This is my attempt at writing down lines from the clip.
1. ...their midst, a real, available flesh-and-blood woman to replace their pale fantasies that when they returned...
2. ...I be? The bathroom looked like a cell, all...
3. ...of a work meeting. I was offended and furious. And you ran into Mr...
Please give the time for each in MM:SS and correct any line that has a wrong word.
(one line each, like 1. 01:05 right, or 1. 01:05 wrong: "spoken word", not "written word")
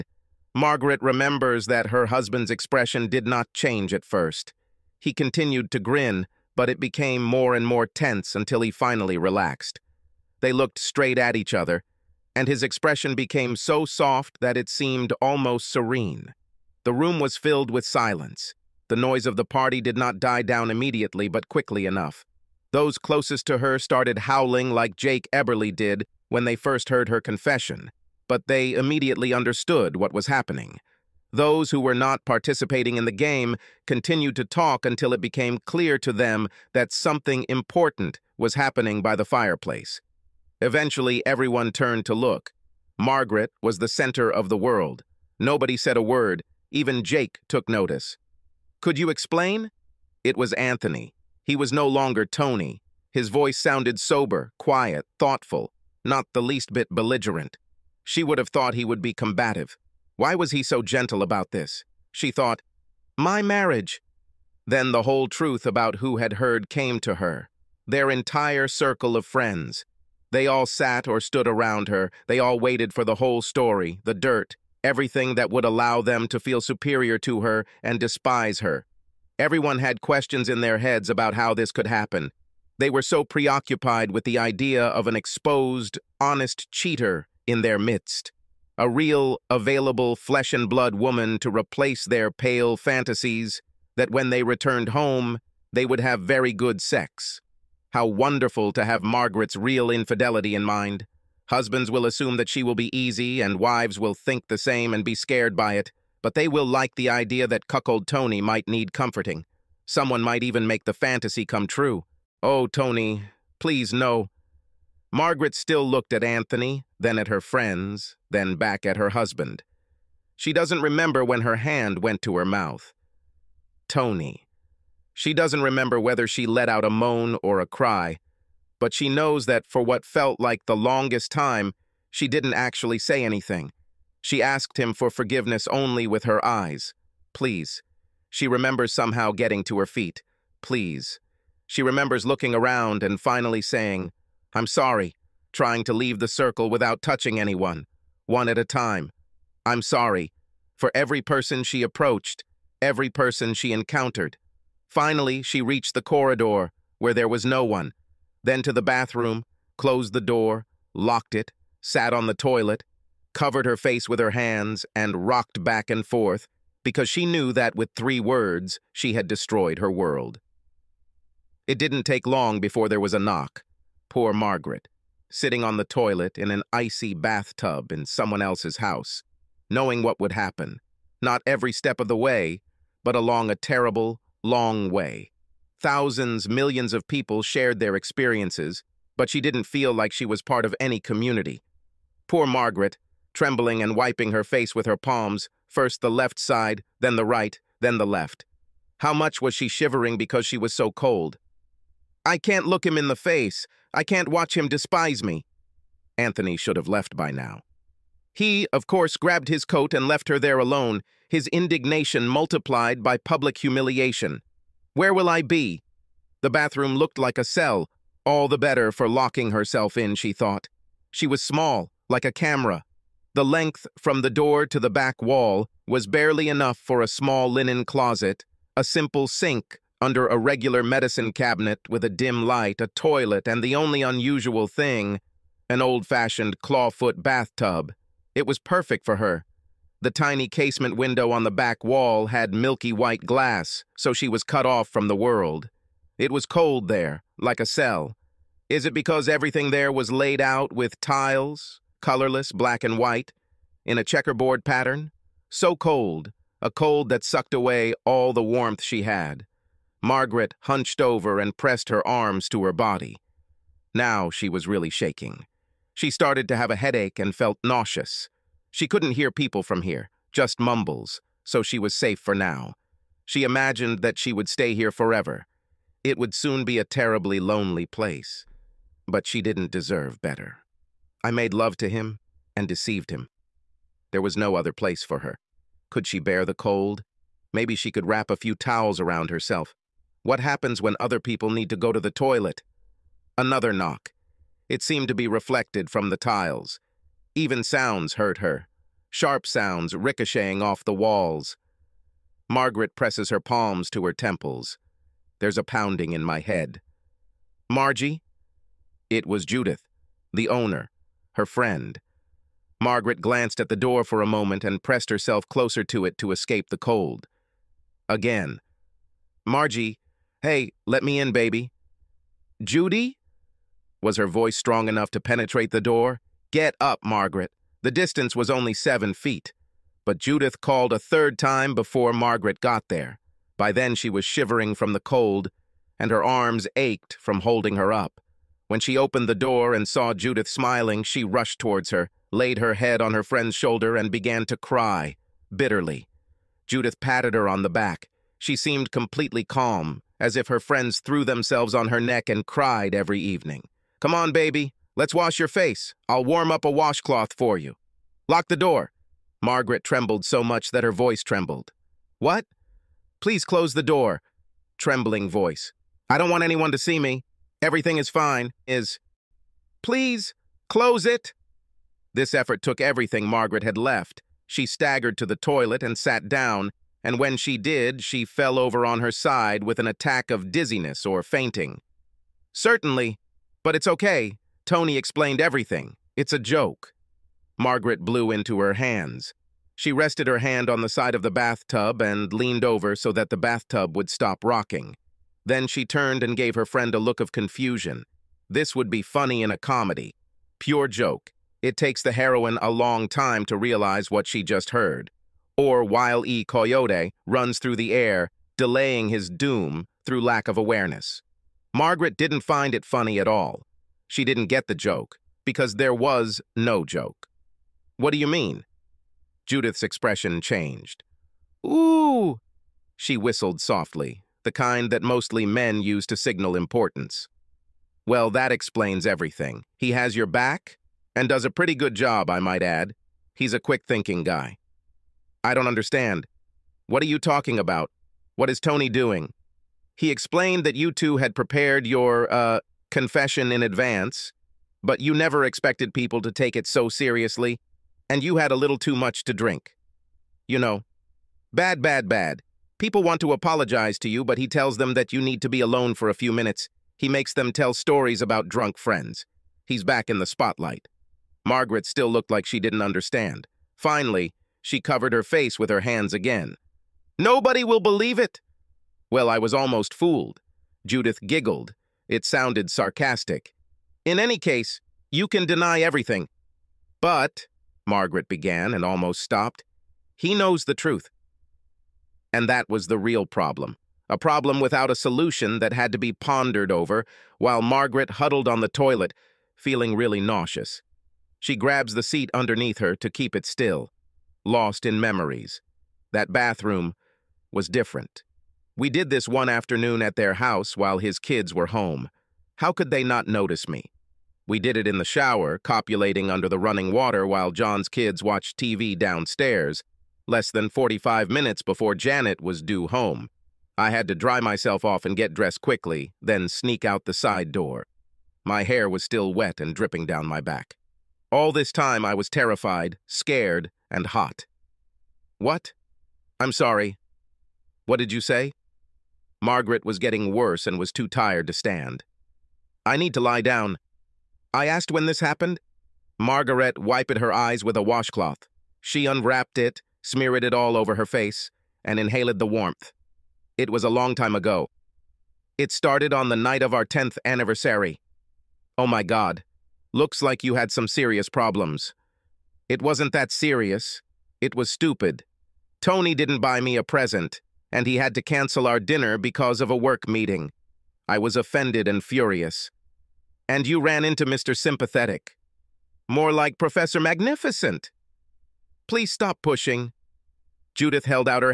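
1. 01:27 right
2. 03:35 right
3. 09:19 right.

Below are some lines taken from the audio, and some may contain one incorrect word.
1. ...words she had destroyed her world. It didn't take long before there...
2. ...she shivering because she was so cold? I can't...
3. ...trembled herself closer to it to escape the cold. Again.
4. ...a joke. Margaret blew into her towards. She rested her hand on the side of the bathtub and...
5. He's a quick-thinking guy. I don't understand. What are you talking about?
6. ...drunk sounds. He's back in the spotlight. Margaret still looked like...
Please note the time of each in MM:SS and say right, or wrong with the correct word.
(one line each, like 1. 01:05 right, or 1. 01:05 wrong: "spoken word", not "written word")
1. 02:48 right
2. 03:19 right
3. 05:14 wrong: "pressed", not "trembled"
4. 06:26 wrong: "hands", not "towards"
5. 07:13 right
6. 07:38 wrong: "friends", not "sounds".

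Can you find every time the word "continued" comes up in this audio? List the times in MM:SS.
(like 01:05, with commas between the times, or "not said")
00:05, 00:33.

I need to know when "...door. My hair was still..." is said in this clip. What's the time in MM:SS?
08:37.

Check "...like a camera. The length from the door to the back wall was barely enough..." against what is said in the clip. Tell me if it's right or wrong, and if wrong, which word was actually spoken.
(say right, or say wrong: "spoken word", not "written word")
right.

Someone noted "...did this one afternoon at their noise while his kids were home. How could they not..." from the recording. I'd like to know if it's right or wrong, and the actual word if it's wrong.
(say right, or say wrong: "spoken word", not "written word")
wrong: "house", not "noise".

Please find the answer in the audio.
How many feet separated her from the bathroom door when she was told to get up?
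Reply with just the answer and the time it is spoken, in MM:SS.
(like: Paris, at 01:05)
7, at 05:28.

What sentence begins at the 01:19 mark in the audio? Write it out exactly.
Everyone had questions in their heads about how this could happen.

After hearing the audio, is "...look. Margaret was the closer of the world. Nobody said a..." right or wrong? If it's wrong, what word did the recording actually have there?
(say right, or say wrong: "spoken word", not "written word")
wrong: "center", not "closer".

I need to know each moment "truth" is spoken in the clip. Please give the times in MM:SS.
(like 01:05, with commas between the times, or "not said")
01:05, 08:00.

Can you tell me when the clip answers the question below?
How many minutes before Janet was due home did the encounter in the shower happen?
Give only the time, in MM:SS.
08:30.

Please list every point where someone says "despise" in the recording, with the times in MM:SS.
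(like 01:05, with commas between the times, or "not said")
01:17, 03:24.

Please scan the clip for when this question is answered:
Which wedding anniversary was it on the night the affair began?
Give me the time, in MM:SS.
09:06.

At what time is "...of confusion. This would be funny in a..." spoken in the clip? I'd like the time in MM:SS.
06:37.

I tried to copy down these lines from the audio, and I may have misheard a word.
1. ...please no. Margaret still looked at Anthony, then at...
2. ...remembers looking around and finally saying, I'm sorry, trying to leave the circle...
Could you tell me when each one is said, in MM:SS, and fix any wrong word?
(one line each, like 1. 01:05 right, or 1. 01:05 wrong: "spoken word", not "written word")
1. 01:53 right
2. 02:21 right.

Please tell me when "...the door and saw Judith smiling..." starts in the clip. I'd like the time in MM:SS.
05:39.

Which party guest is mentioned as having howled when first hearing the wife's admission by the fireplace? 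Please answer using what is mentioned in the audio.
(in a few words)
Jake Eberly.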